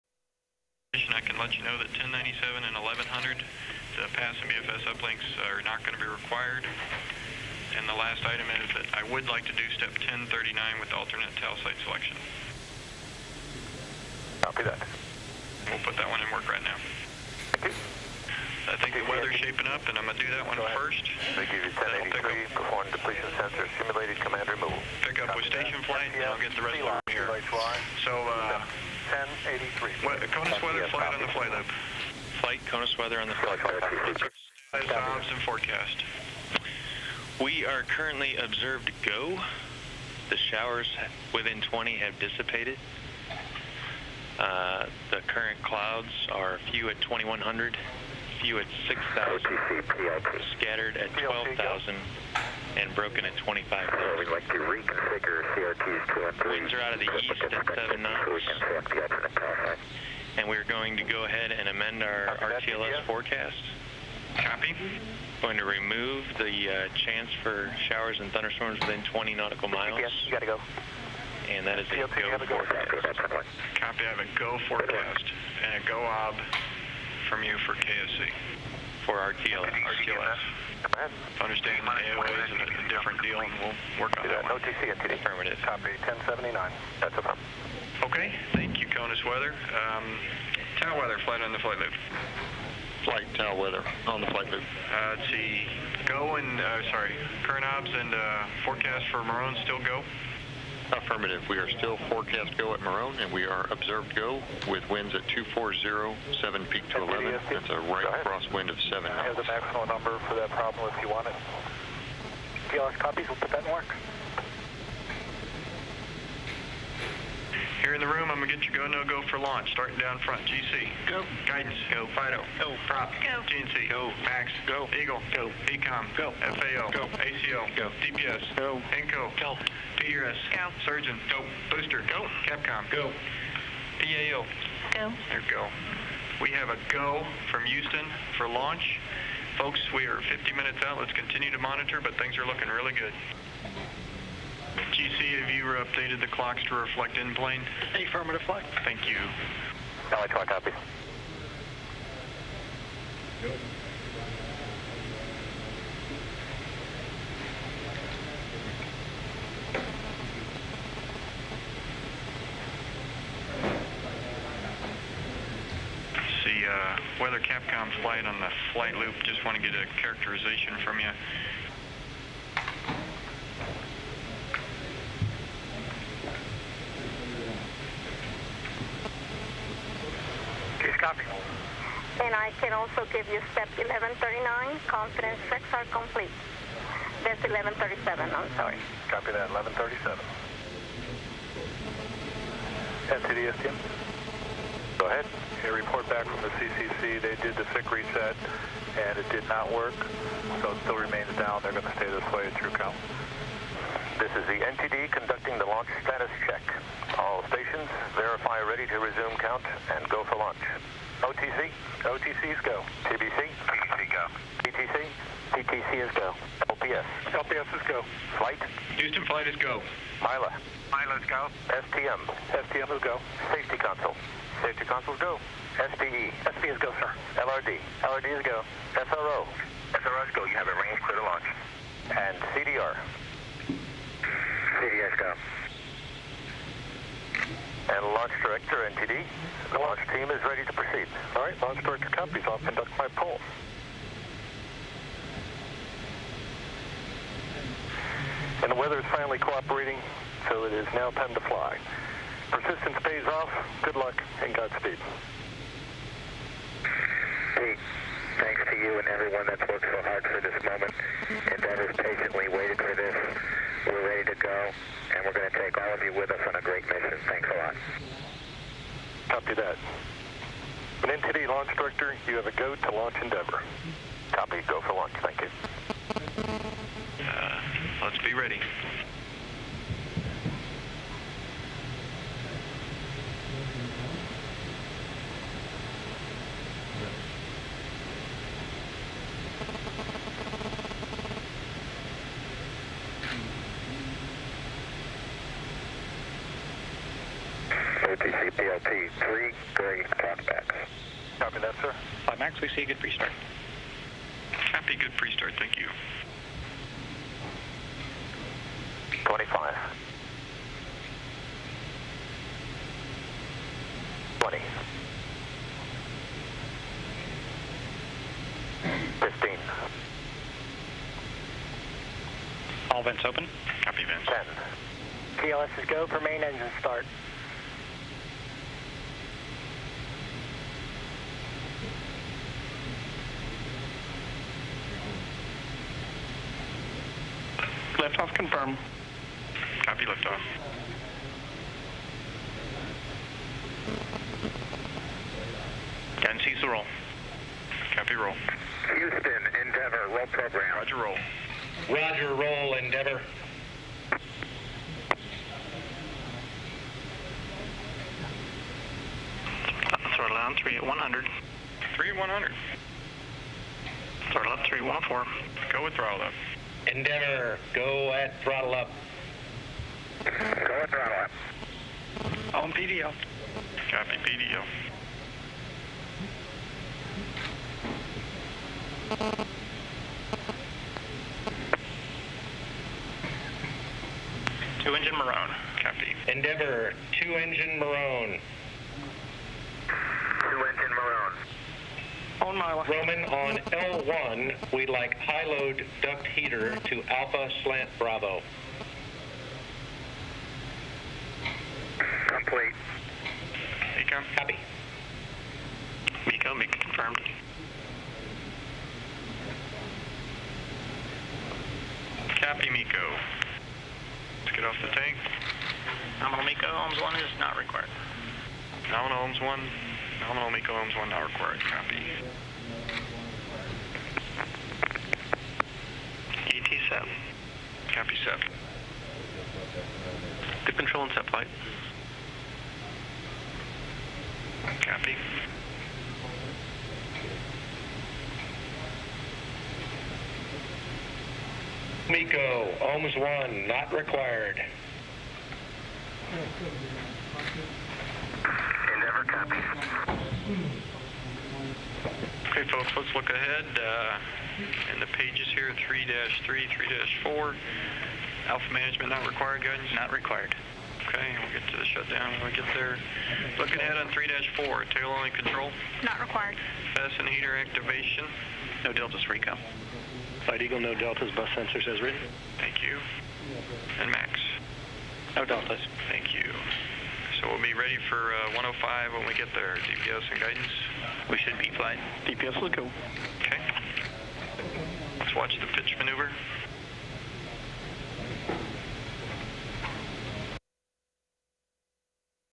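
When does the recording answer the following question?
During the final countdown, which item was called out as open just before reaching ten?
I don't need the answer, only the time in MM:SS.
05:22.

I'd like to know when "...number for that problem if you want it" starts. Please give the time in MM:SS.
01:49.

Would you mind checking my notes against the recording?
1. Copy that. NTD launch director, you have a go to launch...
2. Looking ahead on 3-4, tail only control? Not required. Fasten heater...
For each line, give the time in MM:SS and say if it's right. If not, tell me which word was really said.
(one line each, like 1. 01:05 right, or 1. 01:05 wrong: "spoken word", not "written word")
1. 04:29 right
2. 07:43 right.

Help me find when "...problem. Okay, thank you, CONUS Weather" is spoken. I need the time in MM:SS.
01:27.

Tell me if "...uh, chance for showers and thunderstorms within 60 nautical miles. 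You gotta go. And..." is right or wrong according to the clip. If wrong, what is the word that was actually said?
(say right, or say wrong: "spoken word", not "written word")
wrong: "20", not "60".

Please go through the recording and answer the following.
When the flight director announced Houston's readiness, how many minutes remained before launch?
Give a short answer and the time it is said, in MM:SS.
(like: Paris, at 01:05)
50 minutes, at 02:20.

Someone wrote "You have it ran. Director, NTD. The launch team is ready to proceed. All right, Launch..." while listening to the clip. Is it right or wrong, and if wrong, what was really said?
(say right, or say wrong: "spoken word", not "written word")
right.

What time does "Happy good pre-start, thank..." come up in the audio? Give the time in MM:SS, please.
05:04.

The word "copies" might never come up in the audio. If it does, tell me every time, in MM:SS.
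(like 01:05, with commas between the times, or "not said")
01:52, 04:02.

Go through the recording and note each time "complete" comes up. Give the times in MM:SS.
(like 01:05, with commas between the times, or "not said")
03:05, 06:42.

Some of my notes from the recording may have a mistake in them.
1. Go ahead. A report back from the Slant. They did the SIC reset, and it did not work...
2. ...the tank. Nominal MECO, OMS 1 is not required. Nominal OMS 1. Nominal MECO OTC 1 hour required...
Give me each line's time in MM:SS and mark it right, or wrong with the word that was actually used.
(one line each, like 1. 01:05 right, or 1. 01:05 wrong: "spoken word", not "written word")
1. 03:15 wrong: "CCC", not "Slant"
2. 06:54 wrong: "OMS", not "OTC".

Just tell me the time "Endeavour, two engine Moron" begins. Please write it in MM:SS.
06:26.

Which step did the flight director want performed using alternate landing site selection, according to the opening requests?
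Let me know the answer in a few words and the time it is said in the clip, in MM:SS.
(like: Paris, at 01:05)
1039, at 00:10.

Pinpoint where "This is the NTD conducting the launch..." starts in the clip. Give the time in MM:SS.
03:24.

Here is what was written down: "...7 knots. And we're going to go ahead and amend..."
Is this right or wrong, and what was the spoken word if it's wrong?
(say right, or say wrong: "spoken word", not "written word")
right.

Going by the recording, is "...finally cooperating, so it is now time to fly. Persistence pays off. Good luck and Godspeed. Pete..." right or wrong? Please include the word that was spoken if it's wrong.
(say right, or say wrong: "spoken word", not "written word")
right.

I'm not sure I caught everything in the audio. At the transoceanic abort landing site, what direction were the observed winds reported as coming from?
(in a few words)
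240.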